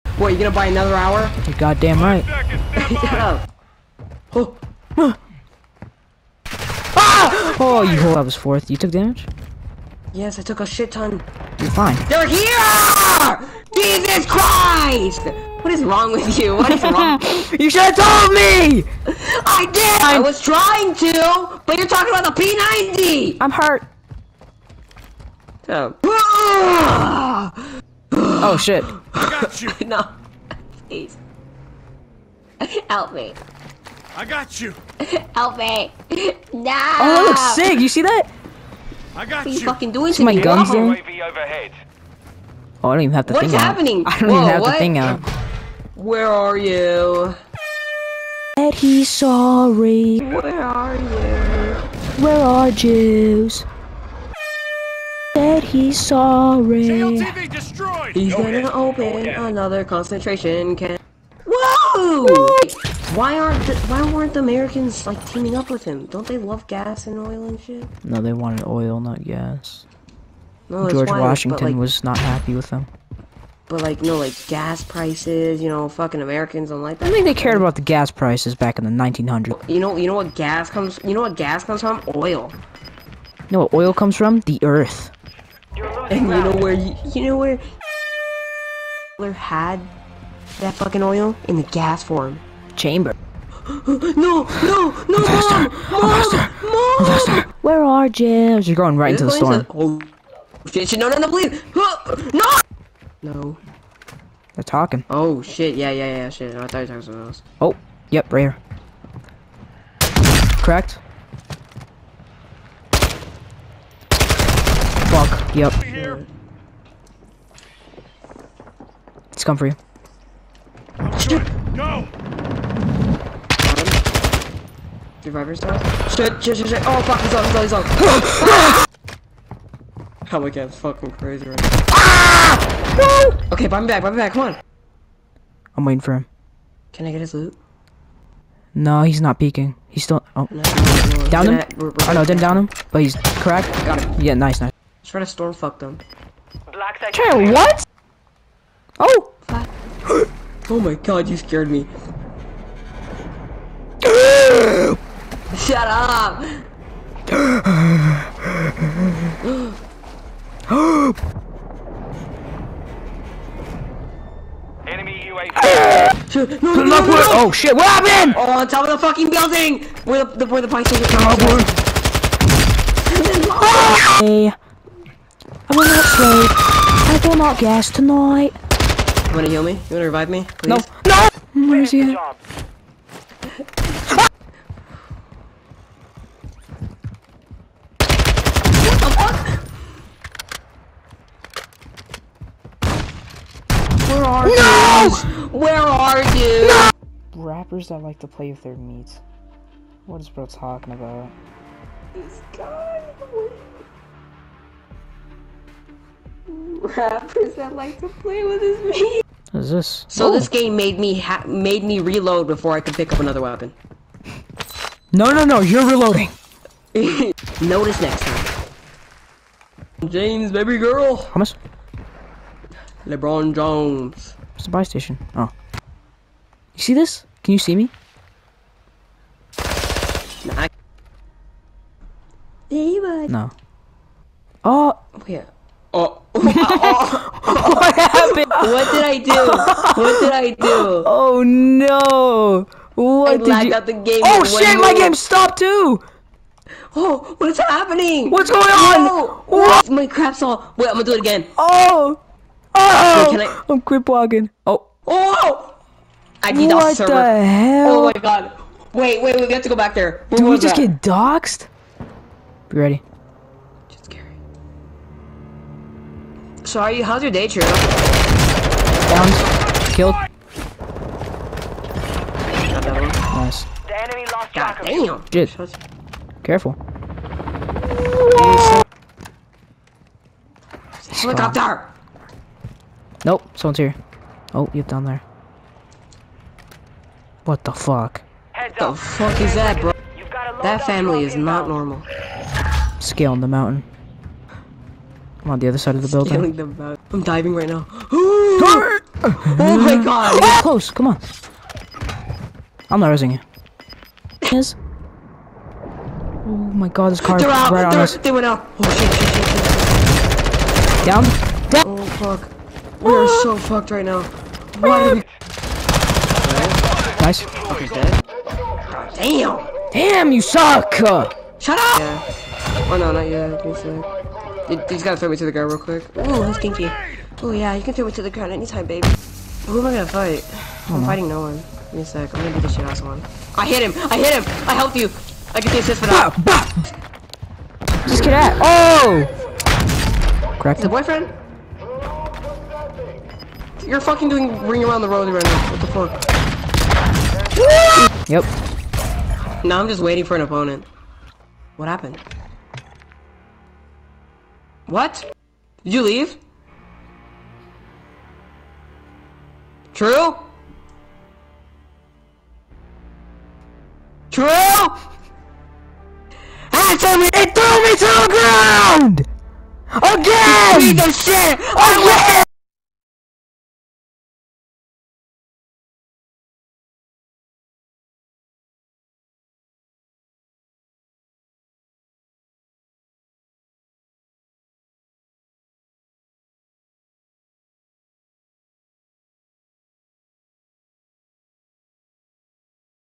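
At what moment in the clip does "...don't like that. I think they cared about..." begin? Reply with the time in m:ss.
1:16.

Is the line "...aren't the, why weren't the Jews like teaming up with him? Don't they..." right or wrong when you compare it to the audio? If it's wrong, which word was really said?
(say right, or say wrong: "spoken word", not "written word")
wrong: "Americans", not "Jews".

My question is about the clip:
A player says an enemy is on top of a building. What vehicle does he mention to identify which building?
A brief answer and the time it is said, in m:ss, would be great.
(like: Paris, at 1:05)
Bike, at 2:50.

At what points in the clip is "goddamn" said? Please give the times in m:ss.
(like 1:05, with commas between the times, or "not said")
0:01.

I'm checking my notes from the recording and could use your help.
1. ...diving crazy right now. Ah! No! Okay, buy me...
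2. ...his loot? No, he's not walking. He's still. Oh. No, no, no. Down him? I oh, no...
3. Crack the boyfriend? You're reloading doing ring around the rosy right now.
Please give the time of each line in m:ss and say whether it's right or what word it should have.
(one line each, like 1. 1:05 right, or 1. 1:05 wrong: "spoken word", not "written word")
1. 2:10 wrong: "fucking", not "diving"
2. 2:17 wrong: "peeking", not "walking"
3. 5:40 wrong: "fucking", not "reloading".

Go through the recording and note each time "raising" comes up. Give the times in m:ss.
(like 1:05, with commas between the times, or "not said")
5:03.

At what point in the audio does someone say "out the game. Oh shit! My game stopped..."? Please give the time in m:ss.
4:03.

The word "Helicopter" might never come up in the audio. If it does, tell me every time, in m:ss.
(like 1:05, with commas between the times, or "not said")
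4:41.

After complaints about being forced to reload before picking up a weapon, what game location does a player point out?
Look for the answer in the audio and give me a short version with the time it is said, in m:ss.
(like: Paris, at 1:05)
Buy station, at 3:44.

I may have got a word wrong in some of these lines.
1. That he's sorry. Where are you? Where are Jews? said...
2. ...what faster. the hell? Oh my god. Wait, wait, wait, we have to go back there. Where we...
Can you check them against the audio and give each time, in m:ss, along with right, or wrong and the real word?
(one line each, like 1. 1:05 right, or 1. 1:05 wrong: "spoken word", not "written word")
1. 0:48 right
2. 4:16 wrong: "server", not "faster".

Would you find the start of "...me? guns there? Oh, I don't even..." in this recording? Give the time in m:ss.
0:40.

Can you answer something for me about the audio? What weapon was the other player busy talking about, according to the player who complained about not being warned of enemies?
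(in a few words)
P90.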